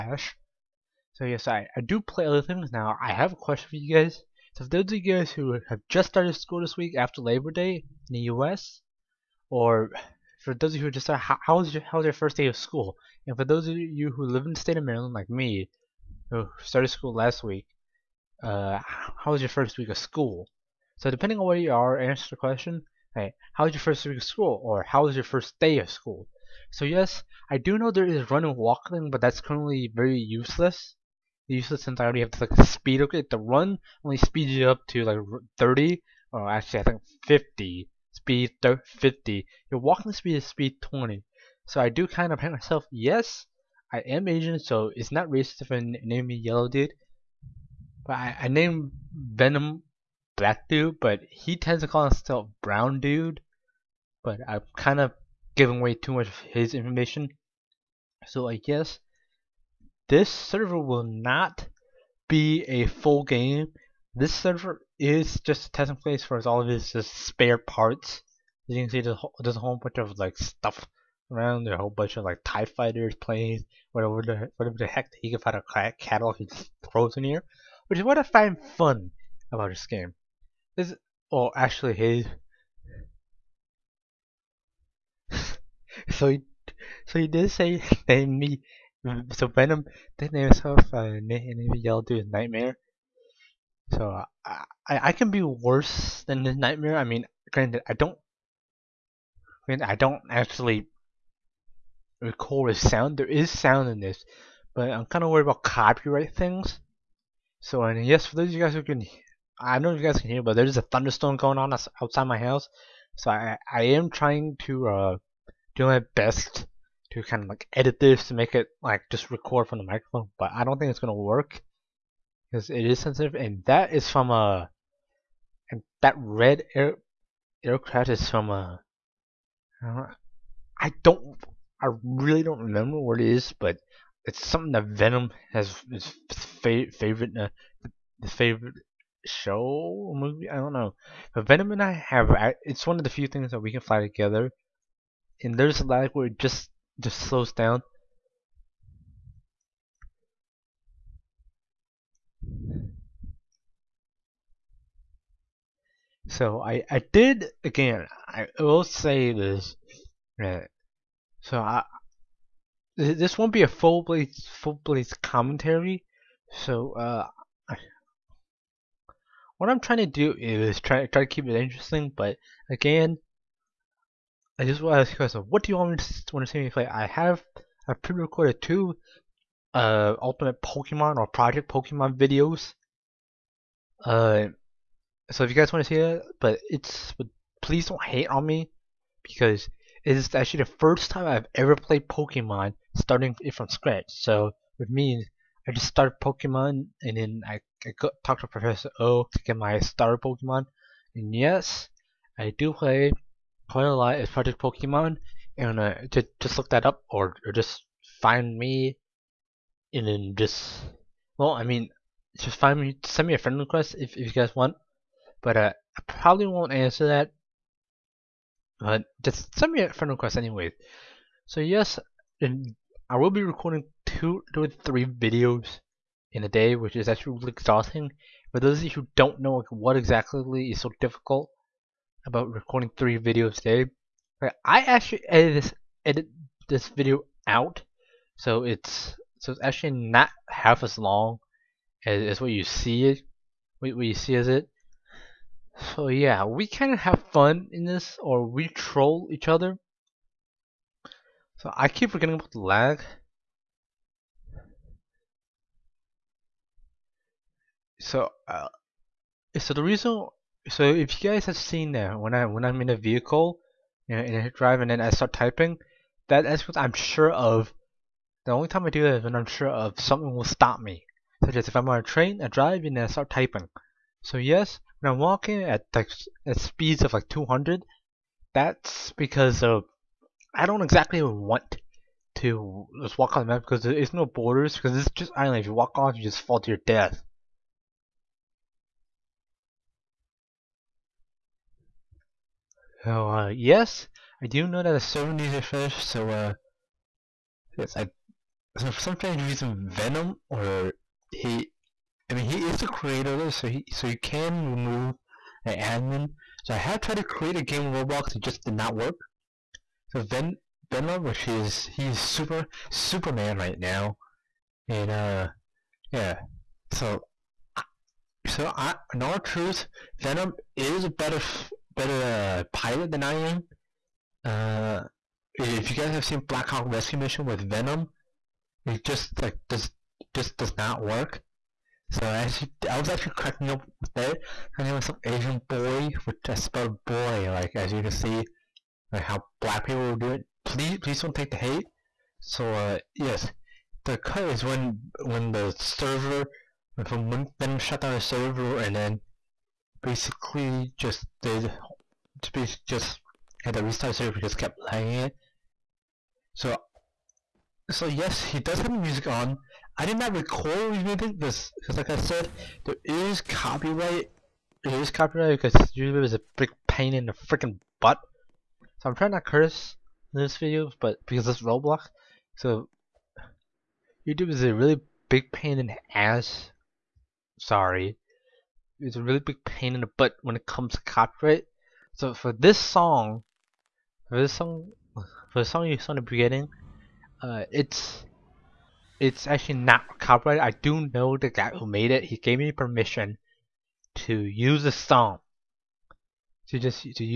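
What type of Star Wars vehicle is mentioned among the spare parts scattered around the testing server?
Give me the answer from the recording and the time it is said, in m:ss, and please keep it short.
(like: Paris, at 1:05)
Tie Fighters, at 1:12.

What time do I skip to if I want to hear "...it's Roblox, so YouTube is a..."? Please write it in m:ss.
6:11.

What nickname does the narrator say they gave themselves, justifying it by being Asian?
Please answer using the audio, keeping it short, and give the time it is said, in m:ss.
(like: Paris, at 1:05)
Yellow Dude, at 0:46.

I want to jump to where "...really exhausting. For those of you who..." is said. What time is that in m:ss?
3:47.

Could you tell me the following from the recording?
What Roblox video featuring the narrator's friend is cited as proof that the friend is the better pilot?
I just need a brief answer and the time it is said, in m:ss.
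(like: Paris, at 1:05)
Black Hawk Rescue Mission, at 5:26.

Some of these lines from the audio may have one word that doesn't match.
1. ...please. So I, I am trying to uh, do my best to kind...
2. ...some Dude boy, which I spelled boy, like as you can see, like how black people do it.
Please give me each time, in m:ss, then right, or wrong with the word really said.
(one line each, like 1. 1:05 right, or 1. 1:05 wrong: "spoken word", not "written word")
1. 1:52 wrong: "house", not "please"
2. 5:35 wrong: "Asian", not "Dude".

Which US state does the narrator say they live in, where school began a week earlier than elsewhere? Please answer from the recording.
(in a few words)
Maryland.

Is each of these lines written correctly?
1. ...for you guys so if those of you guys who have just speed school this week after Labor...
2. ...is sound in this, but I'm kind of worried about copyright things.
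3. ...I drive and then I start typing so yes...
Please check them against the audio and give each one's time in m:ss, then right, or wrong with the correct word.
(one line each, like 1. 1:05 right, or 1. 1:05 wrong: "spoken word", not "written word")
1. 0:03 wrong: "started", not "speed"
2. 1:43 right
3. 4:32 right.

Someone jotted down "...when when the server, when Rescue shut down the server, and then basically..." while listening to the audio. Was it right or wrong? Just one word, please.
wrong.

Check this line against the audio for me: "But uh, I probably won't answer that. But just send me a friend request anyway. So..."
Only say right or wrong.
right.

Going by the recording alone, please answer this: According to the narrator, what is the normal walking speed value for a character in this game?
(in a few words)
20.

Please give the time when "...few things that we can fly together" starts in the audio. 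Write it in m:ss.
2:23.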